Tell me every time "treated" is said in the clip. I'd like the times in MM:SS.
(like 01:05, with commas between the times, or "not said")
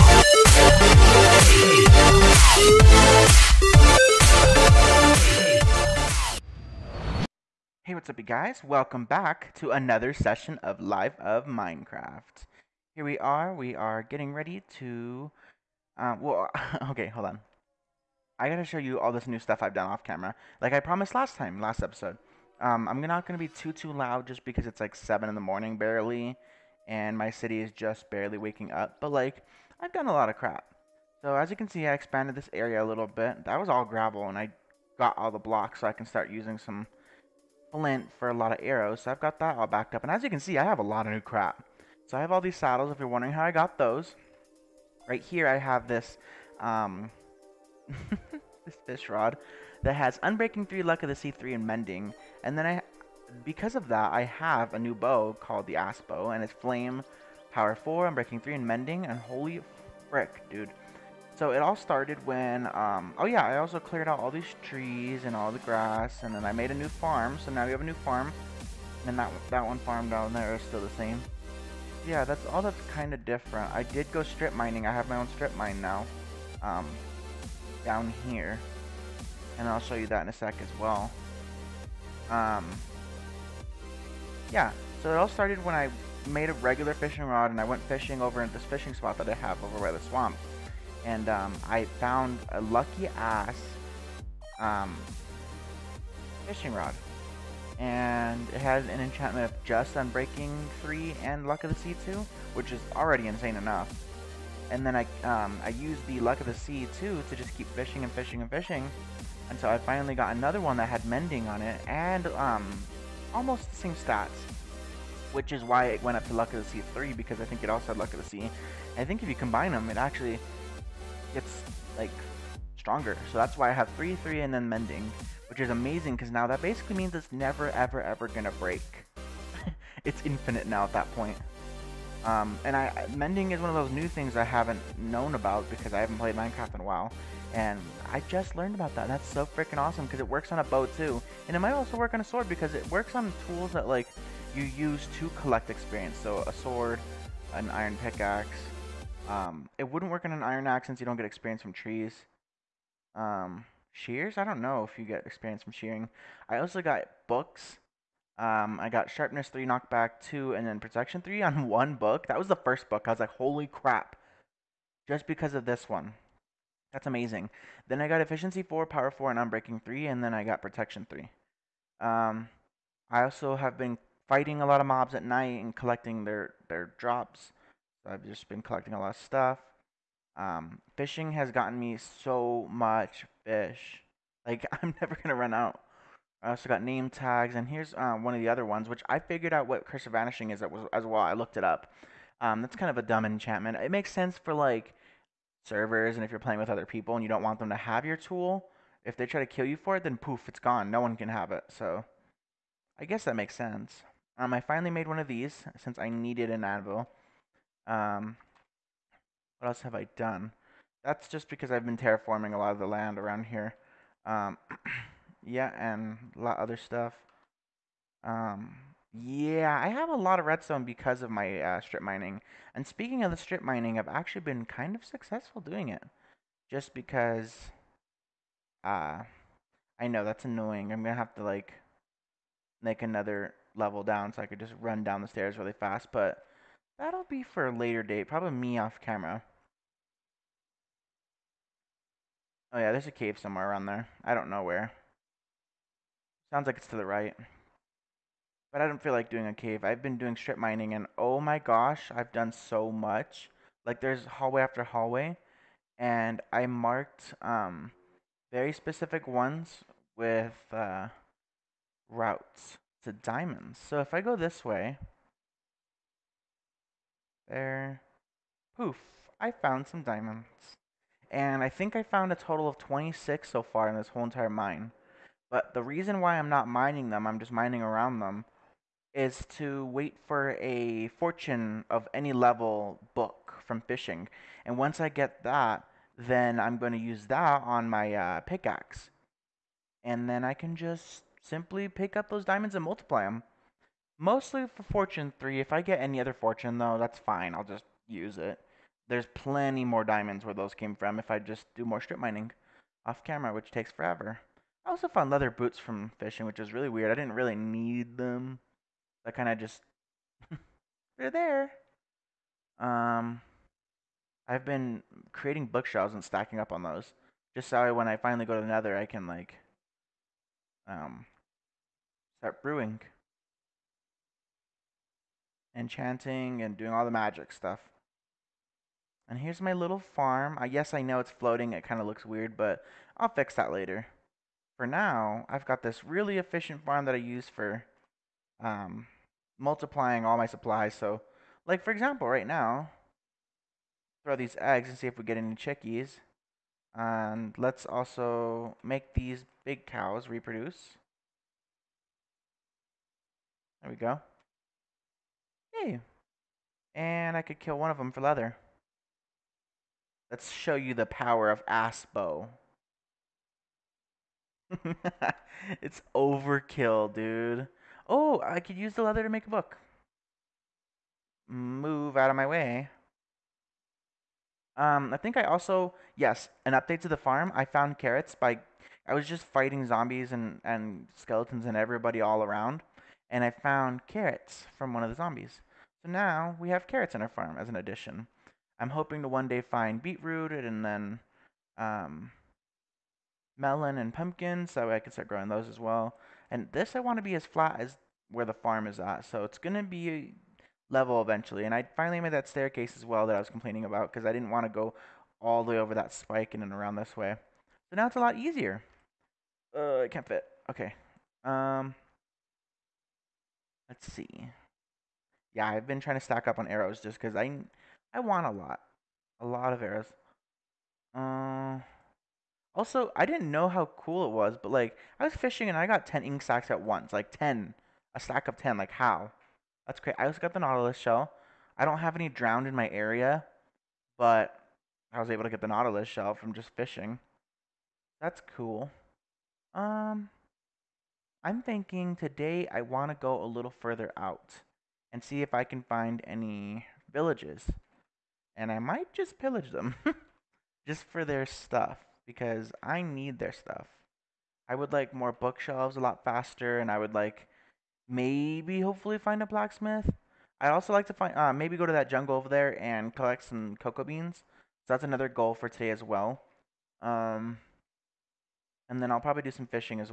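not said.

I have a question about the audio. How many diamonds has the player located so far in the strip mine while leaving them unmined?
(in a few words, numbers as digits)
26.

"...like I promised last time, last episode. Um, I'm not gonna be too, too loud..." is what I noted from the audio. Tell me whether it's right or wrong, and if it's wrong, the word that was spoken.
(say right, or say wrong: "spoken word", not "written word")
right.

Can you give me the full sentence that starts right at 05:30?
I guess I know it's floating.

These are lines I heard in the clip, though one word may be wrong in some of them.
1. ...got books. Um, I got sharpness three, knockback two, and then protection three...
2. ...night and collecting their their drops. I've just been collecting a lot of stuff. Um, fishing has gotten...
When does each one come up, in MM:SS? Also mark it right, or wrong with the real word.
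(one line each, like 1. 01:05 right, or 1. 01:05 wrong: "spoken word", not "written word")
1. 02:36 right
2. 02:55 right.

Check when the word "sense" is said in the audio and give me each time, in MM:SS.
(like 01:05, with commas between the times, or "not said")
03:14, 03:23.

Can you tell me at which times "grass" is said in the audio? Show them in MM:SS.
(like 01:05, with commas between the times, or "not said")
01:05.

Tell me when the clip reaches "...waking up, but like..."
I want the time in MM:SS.
00:28.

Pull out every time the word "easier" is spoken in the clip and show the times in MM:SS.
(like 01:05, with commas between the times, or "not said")
06:48.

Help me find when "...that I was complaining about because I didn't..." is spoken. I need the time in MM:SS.
06:43.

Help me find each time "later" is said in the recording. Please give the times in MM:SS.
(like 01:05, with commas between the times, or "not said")
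03:57, 05:33.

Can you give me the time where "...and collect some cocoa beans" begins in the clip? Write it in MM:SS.
07:42.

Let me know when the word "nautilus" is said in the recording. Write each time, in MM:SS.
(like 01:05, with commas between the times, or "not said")
07:10, 07:15.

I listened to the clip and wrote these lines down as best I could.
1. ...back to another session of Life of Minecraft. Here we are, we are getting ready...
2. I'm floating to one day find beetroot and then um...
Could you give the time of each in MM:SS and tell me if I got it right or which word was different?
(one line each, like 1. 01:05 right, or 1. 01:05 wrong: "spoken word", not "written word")
1. 00:09 right
2. 06:28 wrong: "hoping", not "floating".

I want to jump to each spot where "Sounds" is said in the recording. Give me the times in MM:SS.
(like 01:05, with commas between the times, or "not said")
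04:06.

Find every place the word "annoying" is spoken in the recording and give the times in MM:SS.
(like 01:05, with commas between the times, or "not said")
03:50.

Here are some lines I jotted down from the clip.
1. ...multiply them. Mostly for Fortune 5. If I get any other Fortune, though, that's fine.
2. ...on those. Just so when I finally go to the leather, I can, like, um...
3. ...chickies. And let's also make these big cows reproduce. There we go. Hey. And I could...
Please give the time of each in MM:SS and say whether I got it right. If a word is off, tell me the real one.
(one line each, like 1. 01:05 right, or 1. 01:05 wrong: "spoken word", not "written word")
1. 04:52 wrong: "3", not "5"
2. 05:16 wrong: "nether", not "leather"
3. 05:45 right.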